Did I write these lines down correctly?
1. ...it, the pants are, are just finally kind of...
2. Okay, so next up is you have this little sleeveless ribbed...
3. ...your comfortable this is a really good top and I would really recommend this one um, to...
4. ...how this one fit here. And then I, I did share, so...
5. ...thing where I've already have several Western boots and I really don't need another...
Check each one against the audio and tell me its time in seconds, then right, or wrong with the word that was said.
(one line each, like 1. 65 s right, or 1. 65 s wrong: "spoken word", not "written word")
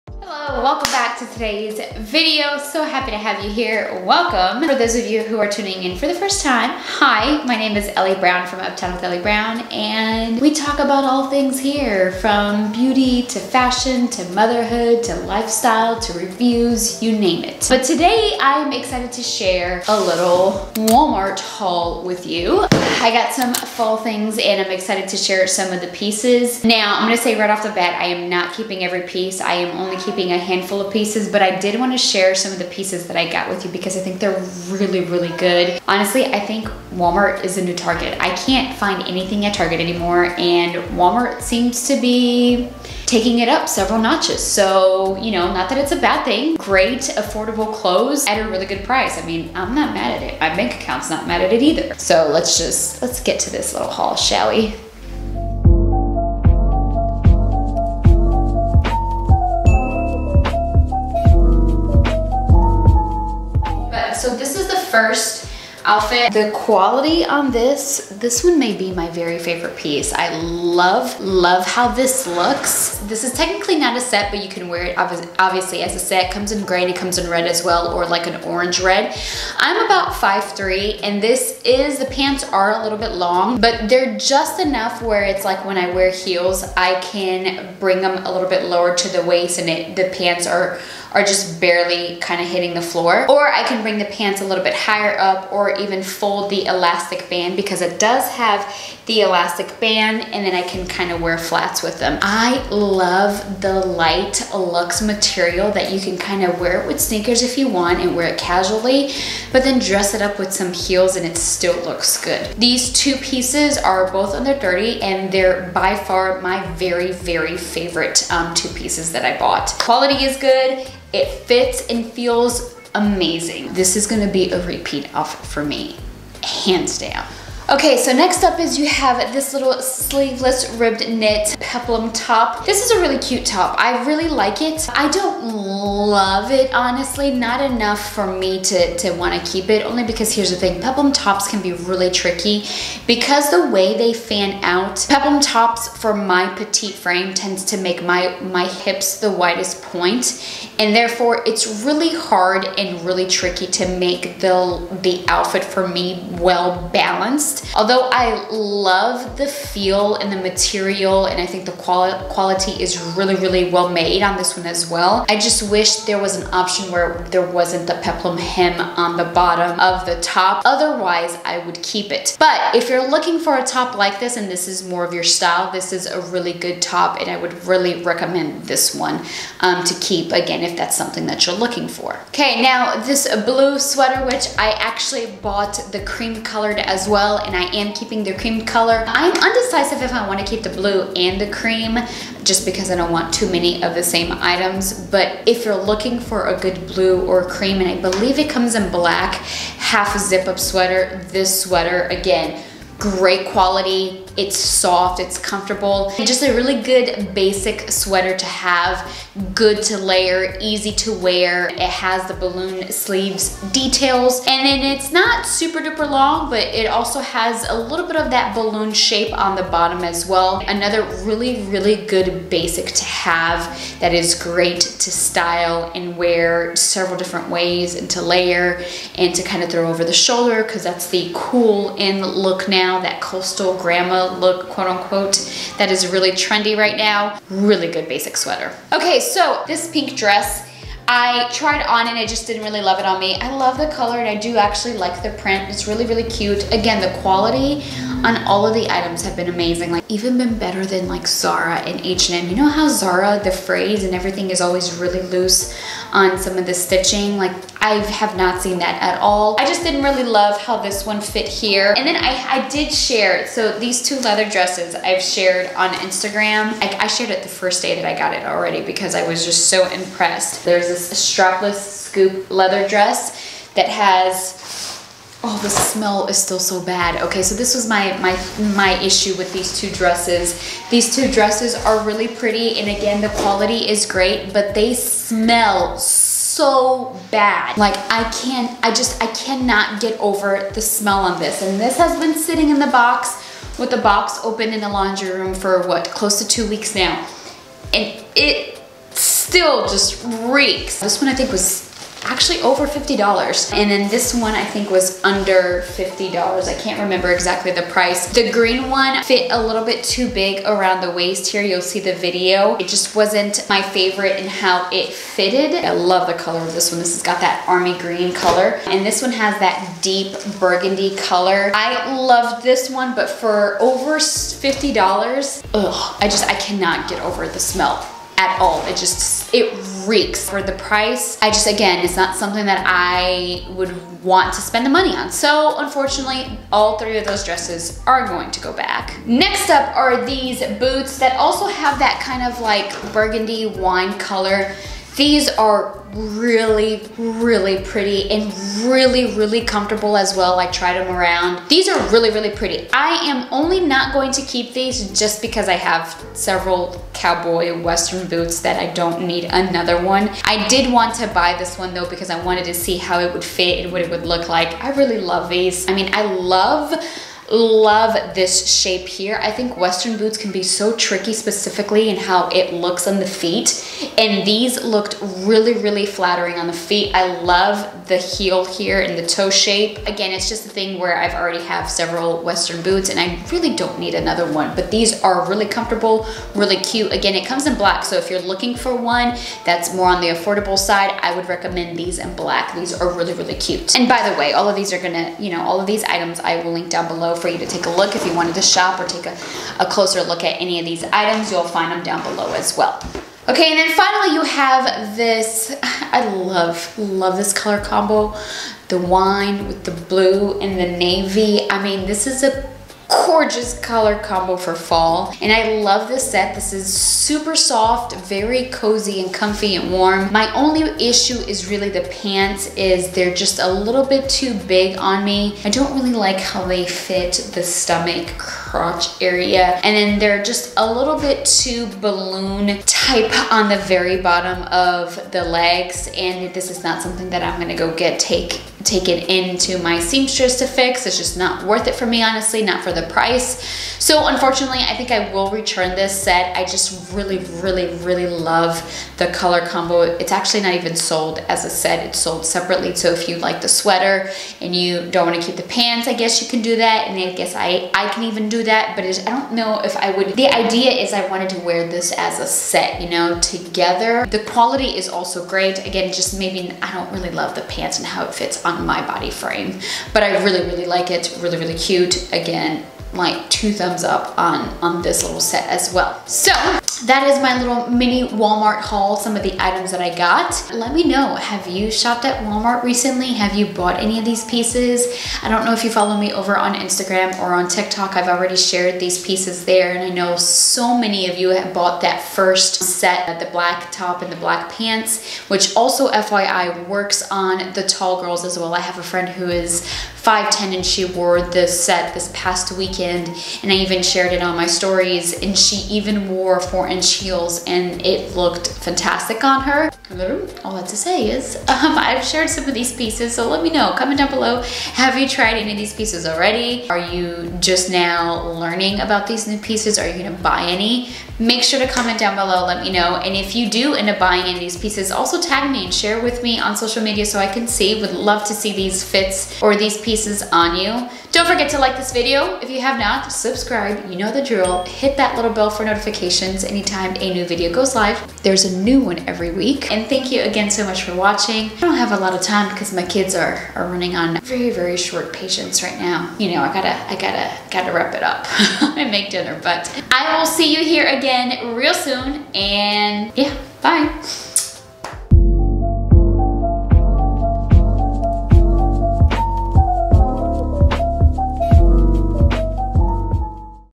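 1. 89 s wrong: "barely", not "finally"
2. 127 s right
3. 175 s wrong: "style", not "comfortable"
4. 260 s right
5. 380 s right.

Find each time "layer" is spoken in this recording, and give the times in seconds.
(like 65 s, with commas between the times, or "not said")
209 s, 228 s.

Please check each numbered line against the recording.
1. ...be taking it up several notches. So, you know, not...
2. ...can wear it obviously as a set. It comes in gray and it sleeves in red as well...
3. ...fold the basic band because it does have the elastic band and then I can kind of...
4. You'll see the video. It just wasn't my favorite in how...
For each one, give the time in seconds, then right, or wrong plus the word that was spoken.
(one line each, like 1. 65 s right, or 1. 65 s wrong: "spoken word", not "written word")
1. 42 s right
2. 74 s wrong: "comes", not "sleeves"
3. 96 s wrong: "elastic", not "basic"
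4. 311 s right.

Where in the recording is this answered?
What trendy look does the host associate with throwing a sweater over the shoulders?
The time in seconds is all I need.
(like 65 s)
233 s.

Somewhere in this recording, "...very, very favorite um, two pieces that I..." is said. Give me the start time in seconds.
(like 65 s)
116 s.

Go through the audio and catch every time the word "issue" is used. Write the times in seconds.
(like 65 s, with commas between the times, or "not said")
279 s, 421 s.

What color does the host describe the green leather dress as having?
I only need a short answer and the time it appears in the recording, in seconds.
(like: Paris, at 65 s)
Army green, at 317 s.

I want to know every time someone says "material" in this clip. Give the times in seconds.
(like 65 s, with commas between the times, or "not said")
105 s, 160 s.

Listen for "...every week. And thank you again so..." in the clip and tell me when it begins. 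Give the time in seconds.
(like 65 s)
539 s.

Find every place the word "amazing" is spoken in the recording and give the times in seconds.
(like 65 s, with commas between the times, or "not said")
122 s, 249 s.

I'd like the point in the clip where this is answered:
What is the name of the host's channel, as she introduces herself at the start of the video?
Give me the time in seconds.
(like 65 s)
8 s.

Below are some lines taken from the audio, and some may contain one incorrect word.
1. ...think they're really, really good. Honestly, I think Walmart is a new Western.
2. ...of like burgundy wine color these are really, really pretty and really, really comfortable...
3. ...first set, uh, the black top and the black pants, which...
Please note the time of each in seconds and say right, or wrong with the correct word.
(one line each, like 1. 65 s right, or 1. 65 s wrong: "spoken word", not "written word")
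1. 34 s wrong: "Target", not "Western"
2. 342 s right
3. 492 s right.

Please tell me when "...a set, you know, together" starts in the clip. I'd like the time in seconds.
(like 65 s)
462 s.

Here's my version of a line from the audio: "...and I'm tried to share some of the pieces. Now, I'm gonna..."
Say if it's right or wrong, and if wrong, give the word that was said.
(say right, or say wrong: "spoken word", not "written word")
wrong: "excited", not "tried".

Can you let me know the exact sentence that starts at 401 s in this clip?
You'll find them down below as well.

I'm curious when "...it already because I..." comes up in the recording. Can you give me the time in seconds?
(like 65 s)
268 s.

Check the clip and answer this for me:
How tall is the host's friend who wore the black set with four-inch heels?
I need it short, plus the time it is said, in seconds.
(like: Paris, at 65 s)
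5'10, at 500 s.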